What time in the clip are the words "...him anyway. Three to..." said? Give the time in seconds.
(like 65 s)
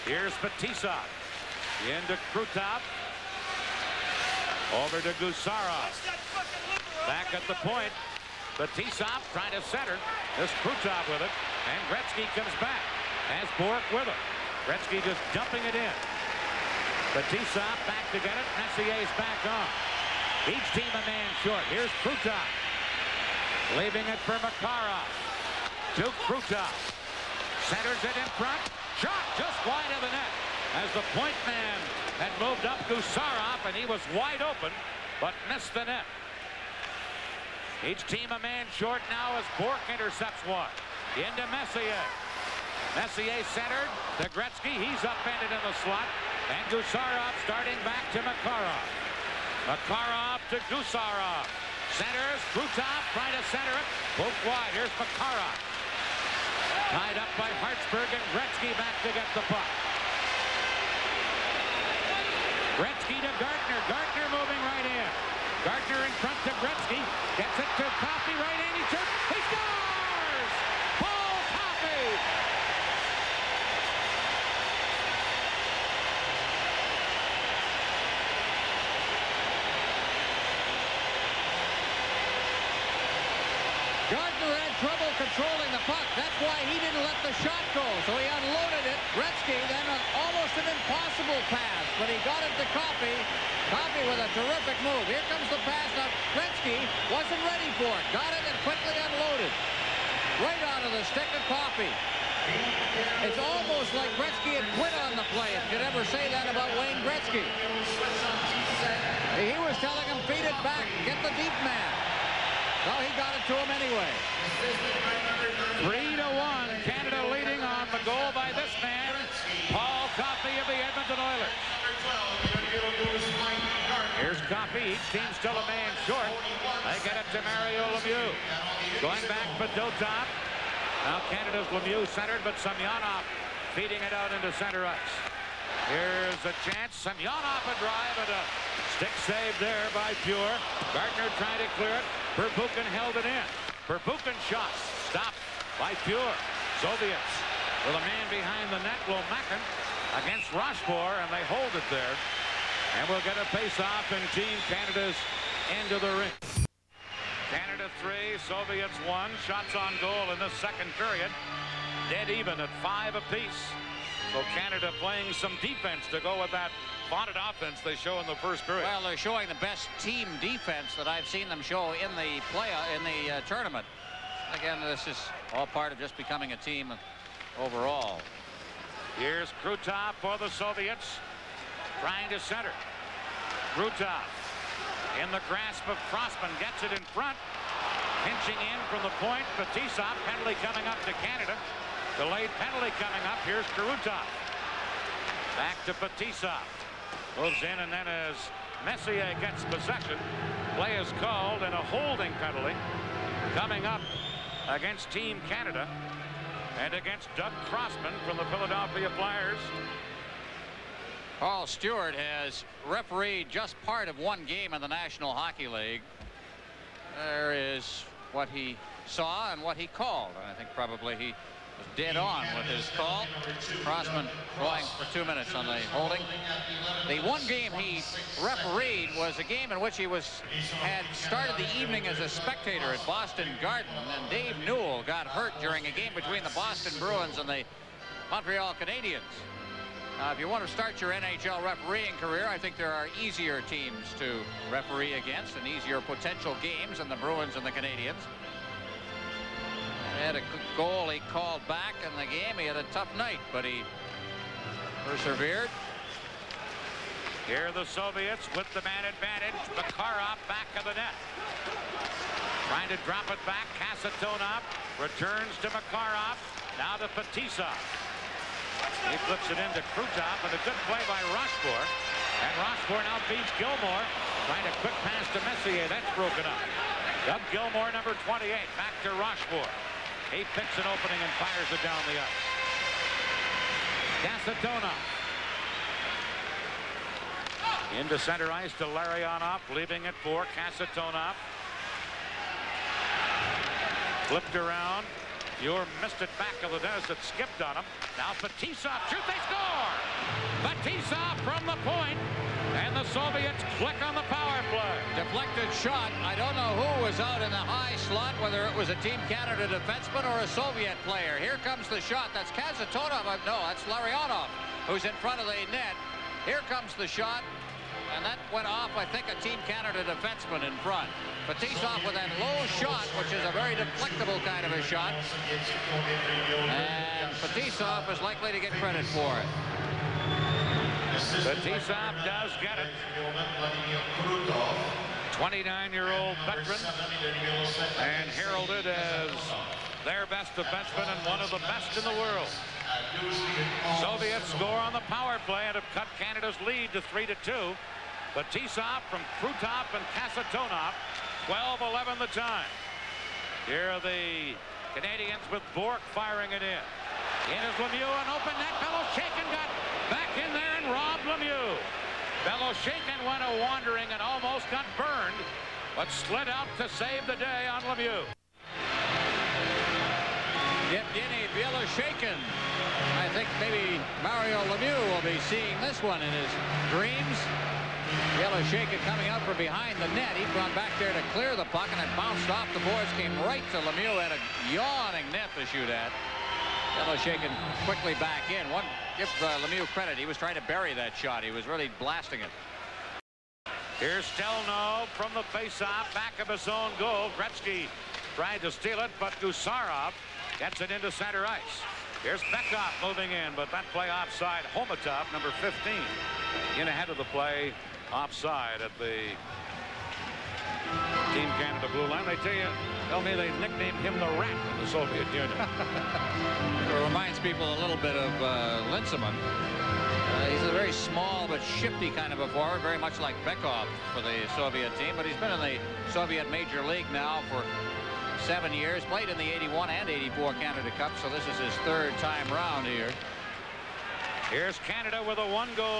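113 s.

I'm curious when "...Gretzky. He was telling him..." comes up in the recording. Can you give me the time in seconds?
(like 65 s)
107 s.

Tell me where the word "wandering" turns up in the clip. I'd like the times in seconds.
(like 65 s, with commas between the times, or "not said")
363 s.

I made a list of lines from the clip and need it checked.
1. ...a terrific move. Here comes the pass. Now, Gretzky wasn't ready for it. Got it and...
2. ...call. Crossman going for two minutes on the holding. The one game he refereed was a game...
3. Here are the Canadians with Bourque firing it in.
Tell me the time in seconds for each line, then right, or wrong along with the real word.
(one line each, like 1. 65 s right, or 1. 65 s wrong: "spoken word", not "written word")
1. 94 s right
2. 222 s right
3. 353 s right.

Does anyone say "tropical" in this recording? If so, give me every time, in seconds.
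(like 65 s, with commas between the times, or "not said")
not said.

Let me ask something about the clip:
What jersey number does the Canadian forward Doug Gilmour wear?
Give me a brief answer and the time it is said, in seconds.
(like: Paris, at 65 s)
28, at 277 s.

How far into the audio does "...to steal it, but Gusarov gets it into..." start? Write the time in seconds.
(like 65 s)
398 s.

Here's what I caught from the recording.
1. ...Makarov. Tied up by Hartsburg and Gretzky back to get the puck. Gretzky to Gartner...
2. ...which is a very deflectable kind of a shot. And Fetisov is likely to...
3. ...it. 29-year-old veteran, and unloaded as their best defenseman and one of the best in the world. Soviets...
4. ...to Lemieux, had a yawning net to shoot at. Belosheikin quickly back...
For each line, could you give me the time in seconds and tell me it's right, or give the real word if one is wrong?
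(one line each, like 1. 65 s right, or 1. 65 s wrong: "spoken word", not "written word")
1. 54 s right
2. 323 s right
3. 332 s wrong: "heralded", not "unloaded"
4. 383 s right.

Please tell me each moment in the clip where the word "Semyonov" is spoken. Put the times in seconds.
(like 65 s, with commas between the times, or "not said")
132 s, 136 s.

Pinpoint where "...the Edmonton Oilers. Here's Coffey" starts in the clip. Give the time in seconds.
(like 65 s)
120 s.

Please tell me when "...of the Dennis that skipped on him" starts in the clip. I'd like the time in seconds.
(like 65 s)
296 s.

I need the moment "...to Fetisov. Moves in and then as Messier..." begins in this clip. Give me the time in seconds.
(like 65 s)
195 s.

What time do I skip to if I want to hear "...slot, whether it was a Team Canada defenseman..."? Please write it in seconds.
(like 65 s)
308 s.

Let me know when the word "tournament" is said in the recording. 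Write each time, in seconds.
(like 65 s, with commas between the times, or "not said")
173 s.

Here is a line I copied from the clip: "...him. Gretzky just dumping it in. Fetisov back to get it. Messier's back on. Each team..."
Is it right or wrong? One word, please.
right.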